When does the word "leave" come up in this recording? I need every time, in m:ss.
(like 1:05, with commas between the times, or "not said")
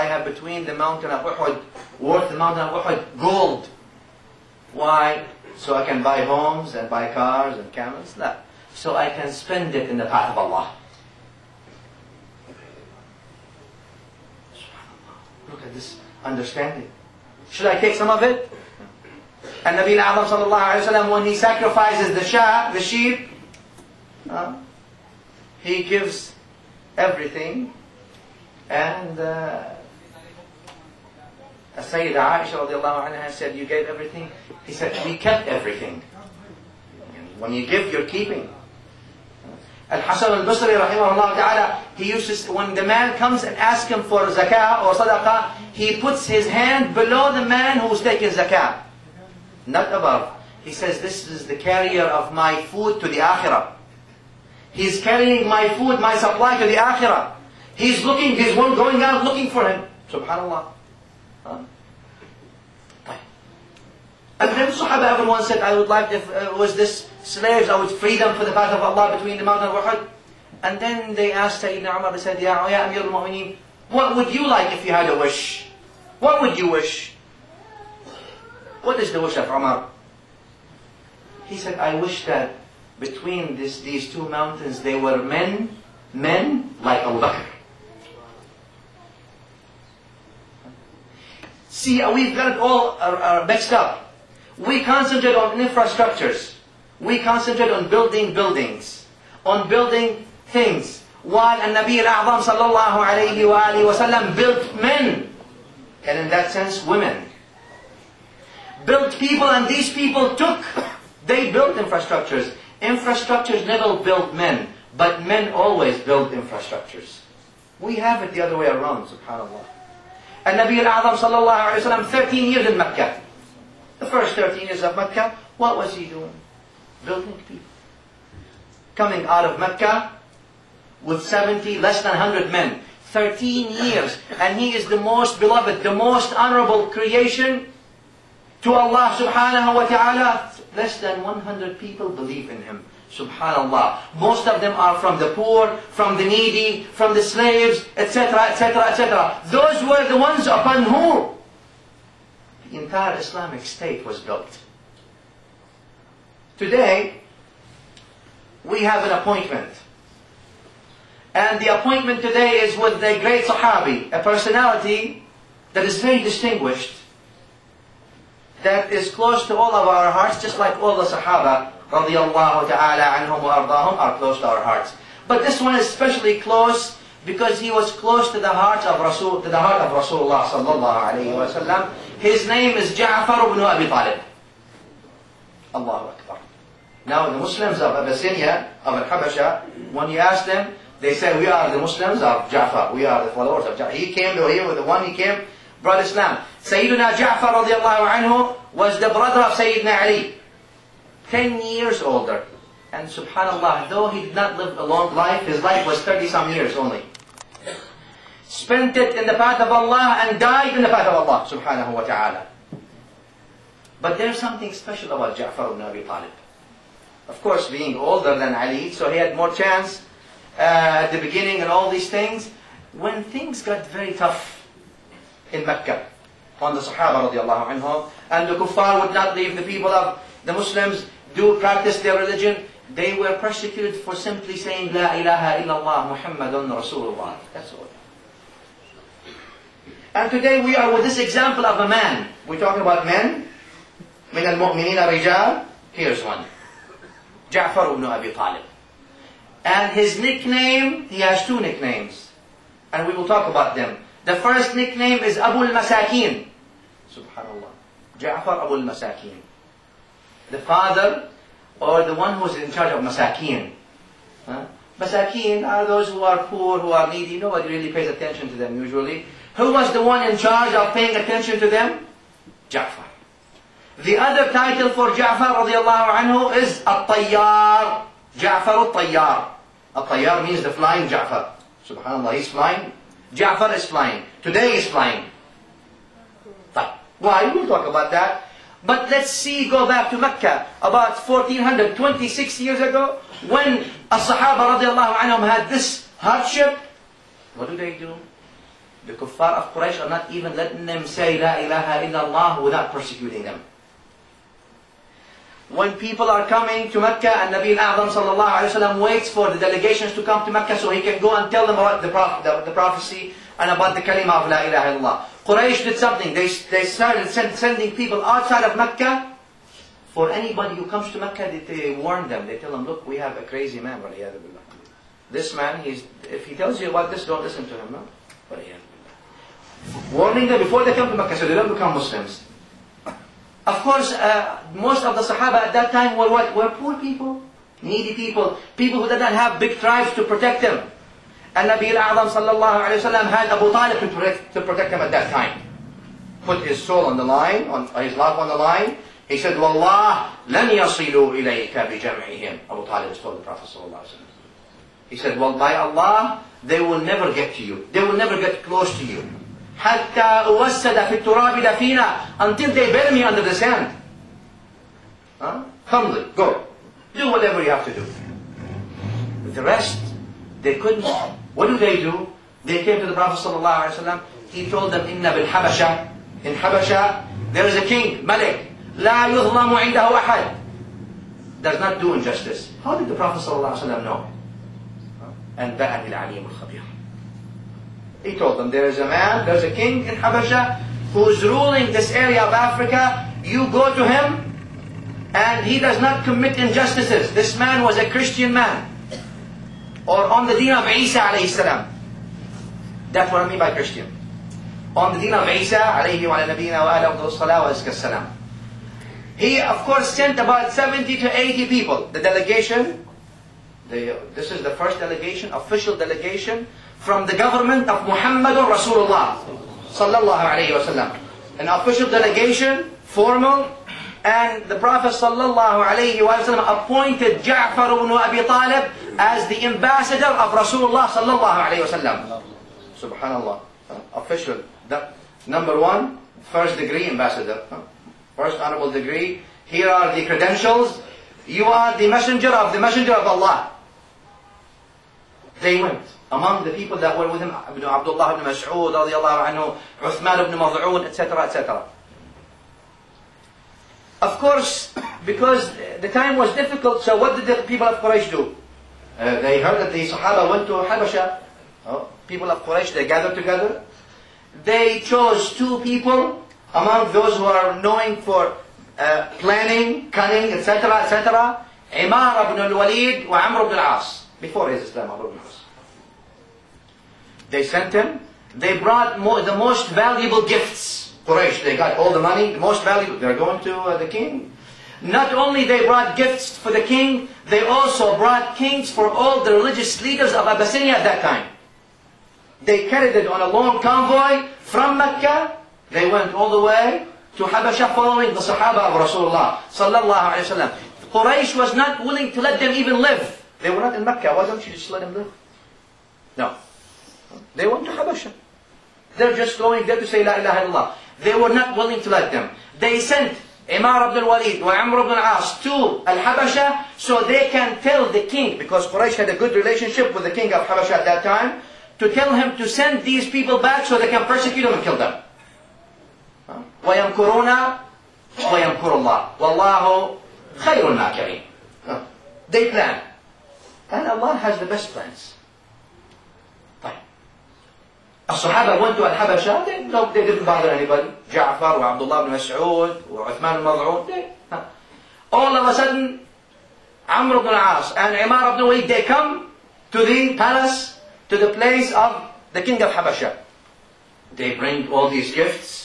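3:49.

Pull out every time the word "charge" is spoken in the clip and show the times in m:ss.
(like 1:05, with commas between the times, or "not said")
4:22, 4:30.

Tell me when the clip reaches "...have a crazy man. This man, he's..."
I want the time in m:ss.
5:23.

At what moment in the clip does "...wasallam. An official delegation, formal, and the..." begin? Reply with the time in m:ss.
7:00.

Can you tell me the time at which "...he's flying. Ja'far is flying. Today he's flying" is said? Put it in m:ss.
4:42.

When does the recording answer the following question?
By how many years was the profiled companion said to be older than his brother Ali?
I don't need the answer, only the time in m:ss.
3:21.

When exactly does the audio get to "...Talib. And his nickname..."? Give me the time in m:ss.
4:08.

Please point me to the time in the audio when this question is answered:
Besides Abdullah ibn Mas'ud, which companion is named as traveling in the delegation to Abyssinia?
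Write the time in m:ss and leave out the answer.
7:30.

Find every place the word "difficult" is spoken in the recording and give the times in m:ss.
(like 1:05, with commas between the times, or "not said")
7:36.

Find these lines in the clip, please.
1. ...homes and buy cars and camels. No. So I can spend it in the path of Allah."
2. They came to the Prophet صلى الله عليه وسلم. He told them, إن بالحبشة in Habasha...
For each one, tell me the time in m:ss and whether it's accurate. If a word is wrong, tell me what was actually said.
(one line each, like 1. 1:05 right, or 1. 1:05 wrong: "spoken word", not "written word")
1. 0:06 right
2. 6:12 right.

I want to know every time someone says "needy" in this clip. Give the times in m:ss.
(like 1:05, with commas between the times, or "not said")
2:26, 4:27, 5:37.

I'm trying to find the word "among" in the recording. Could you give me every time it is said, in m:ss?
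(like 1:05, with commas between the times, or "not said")
7:26, 7:46.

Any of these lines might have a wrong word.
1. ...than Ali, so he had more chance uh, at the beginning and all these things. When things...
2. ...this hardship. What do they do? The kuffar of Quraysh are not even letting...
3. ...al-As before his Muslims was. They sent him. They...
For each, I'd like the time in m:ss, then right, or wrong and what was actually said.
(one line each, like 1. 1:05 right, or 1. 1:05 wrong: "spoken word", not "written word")
1. 3:38 right
2. 4:55 right
3. 7:53 wrong: "Islamabad", not "Muslims".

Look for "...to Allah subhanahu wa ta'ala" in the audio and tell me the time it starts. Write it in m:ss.
2:18.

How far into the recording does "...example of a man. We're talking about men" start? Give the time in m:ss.
4:01.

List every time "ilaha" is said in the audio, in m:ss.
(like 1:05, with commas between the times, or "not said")
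3:55, 5:01, 5:14, 8:30.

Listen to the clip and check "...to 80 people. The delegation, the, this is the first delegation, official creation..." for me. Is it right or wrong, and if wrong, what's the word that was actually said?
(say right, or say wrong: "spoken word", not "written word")
wrong: "delegation", not "creation".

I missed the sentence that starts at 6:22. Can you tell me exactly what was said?
How did the Prophet صلى الله عليه وسلم know?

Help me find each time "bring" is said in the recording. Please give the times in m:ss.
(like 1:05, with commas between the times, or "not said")
9:14.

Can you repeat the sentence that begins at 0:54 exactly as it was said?
He's carrying my food, my supply to the akhirah.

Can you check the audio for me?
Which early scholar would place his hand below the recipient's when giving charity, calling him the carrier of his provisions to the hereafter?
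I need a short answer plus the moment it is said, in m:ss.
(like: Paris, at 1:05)
Al-Hasan al-Basri, at 0:39.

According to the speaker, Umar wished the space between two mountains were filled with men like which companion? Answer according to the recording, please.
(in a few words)
Abu Bakr.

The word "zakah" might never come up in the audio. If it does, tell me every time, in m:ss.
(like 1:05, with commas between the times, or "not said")
0:44, 0:48.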